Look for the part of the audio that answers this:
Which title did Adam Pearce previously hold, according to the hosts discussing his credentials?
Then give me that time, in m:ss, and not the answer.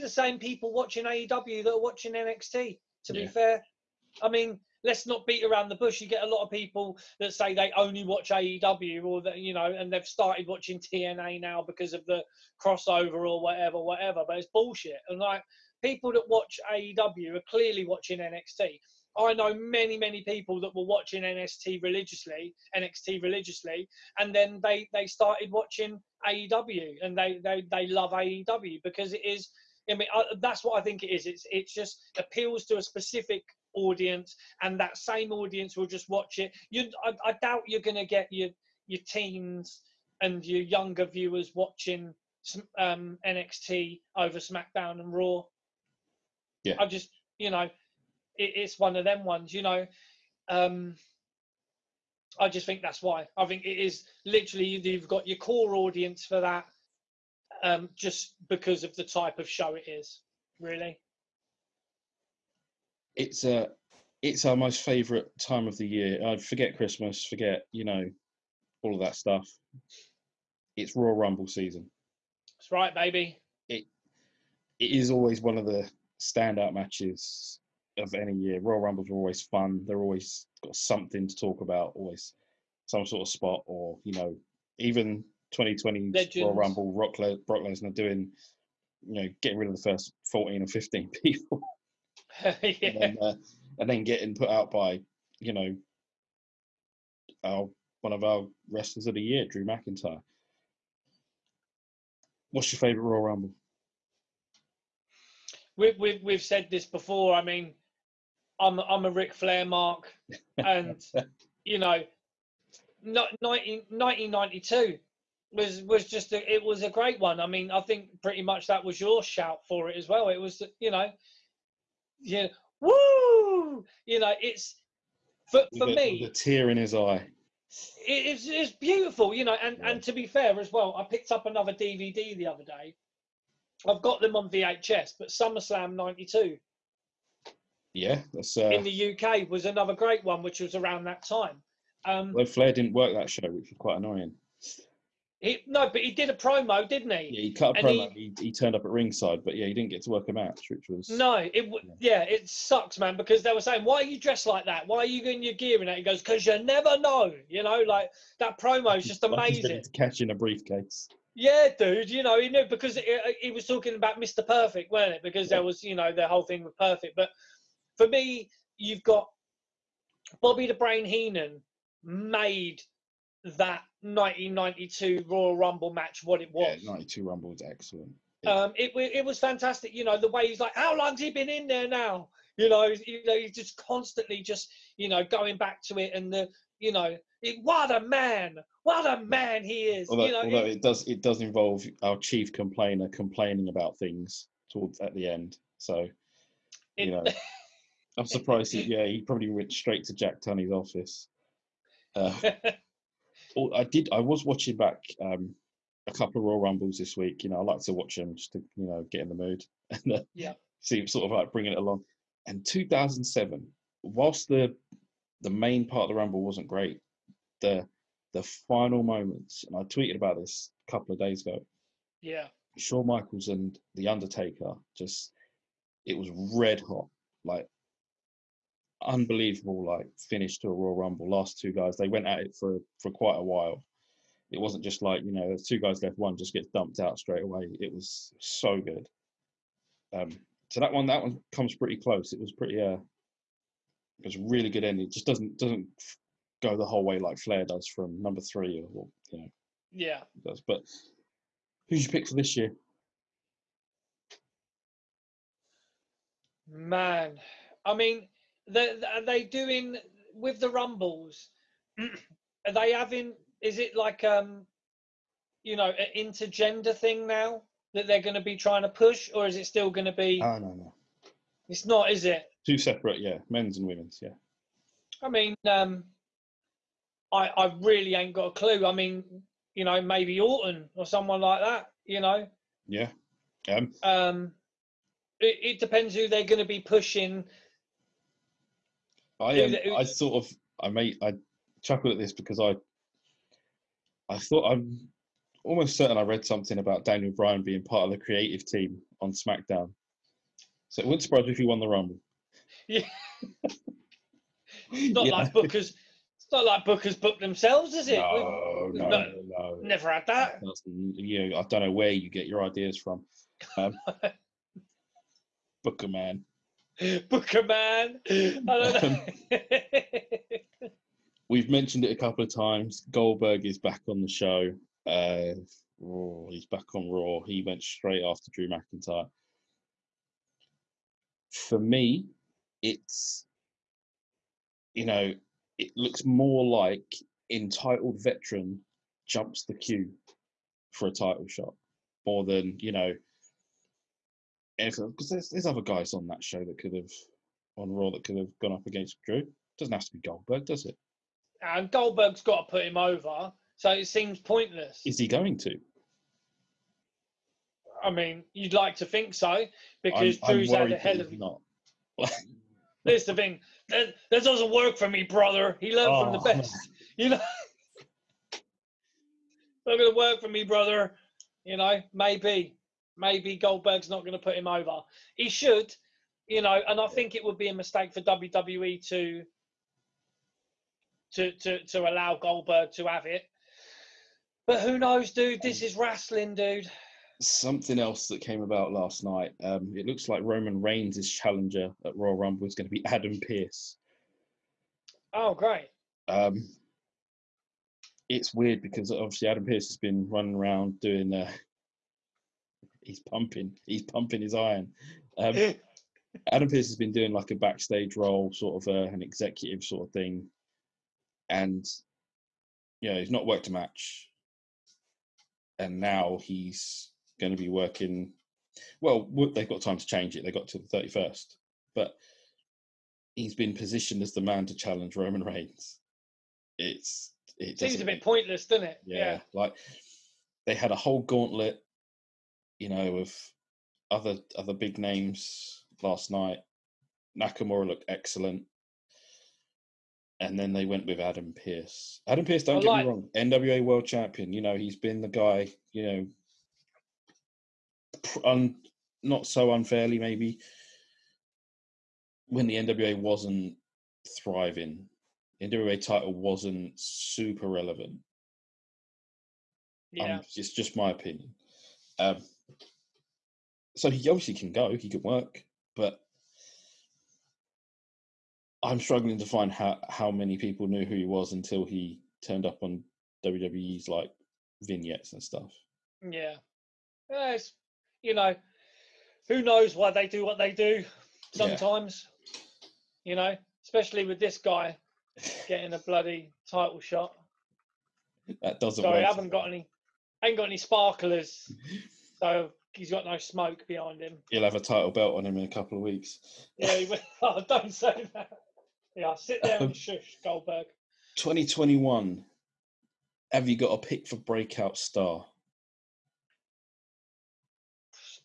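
7:23.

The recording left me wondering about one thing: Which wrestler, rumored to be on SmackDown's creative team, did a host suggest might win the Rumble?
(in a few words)
Daniel Bryan.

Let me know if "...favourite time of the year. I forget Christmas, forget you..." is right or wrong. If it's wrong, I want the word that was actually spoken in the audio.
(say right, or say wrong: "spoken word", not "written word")
right.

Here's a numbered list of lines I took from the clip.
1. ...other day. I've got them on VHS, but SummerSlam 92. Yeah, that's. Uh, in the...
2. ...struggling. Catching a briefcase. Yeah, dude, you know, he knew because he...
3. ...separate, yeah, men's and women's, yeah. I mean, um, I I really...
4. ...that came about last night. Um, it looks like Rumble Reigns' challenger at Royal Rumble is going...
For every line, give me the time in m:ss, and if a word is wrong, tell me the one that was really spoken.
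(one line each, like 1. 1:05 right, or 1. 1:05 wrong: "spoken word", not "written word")
1. 2:12 right
2. 2:39 wrong: "amazing", not "struggling"
3. 4:32 right
4. 6:28 wrong: "Roman", not "Rumble".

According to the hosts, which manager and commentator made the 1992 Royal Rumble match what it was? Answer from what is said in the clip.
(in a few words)
Bobby the Brain Heenan.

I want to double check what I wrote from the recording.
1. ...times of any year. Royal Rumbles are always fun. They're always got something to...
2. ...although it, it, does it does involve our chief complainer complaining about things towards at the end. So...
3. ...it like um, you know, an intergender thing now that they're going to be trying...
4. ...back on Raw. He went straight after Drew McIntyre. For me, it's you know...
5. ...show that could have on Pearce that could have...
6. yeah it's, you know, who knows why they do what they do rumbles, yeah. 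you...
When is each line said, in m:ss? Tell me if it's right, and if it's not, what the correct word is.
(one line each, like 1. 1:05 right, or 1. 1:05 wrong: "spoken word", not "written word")
1. 1:16 wrong: "matches", not "times"
2. 3:10 right
3. 4:23 right
4. 5:26 right
5. 5:46 wrong: "Raw", not "Pearce"
6. 7:57 wrong: "sometimes", not "rumbles".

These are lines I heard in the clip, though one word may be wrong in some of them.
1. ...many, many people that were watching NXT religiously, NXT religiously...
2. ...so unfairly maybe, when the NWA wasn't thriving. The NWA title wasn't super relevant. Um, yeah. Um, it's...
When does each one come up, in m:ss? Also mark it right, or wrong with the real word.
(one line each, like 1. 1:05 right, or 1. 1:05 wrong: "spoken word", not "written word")
1. 0:19 right
2. 7:29 right.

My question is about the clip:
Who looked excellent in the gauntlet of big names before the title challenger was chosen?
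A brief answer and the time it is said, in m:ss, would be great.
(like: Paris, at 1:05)
Nakamura, at 7:17.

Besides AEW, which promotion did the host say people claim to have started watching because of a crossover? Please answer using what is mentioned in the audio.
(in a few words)
TNA.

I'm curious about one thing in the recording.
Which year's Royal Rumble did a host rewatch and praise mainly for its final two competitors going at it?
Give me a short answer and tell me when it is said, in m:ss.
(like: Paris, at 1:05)
2007, at 3:32.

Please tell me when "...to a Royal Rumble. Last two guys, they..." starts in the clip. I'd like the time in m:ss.
3:50.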